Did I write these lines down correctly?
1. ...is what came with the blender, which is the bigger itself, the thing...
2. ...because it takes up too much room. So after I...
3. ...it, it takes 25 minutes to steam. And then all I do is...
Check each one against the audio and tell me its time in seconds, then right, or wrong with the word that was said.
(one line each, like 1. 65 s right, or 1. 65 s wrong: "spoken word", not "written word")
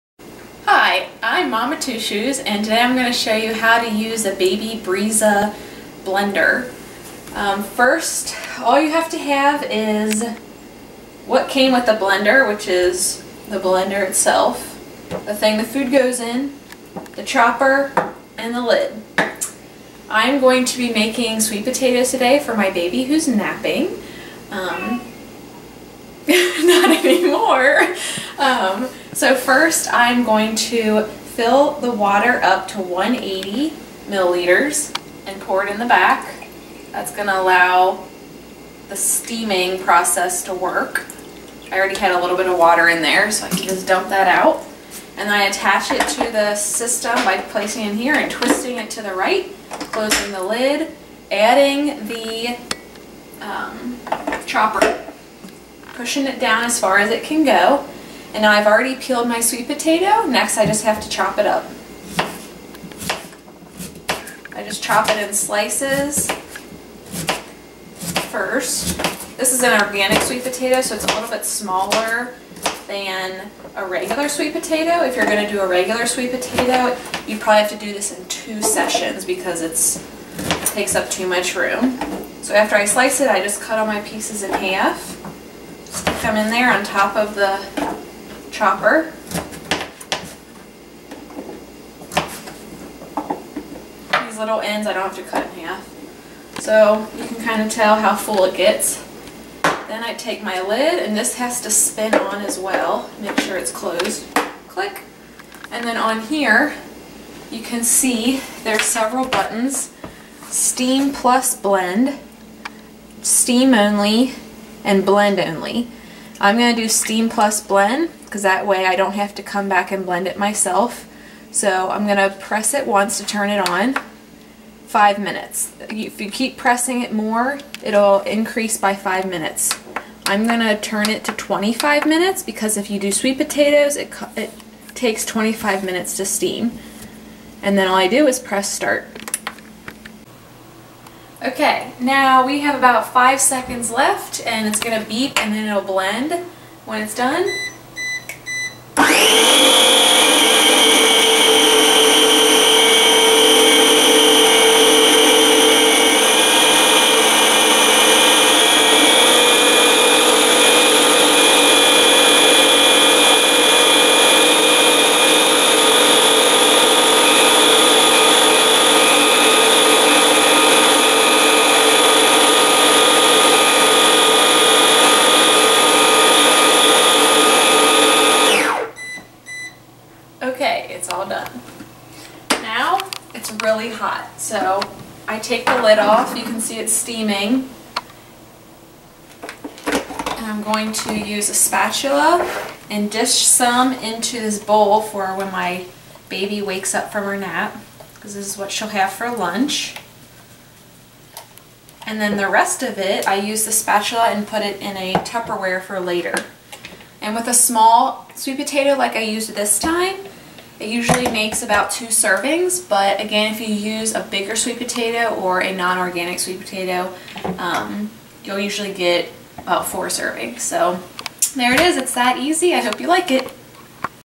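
1. 9 s wrong: "blender", not "bigger"
2. 79 s right
3. 133 s right.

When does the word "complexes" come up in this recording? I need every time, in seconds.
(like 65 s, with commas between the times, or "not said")
not said.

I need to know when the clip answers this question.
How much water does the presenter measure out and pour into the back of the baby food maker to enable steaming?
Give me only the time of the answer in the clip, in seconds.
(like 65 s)
32 s.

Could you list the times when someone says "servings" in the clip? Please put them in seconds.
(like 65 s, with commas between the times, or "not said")
212 s, 220 s.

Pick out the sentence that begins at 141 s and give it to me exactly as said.
Okay, now we have about five seconds left and it's going to beep and then it'll blend when it's done.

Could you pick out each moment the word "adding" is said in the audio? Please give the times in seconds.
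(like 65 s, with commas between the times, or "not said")
51 s.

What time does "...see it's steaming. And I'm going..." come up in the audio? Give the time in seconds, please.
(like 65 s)
186 s.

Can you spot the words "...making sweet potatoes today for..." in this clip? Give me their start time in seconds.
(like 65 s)
20 s.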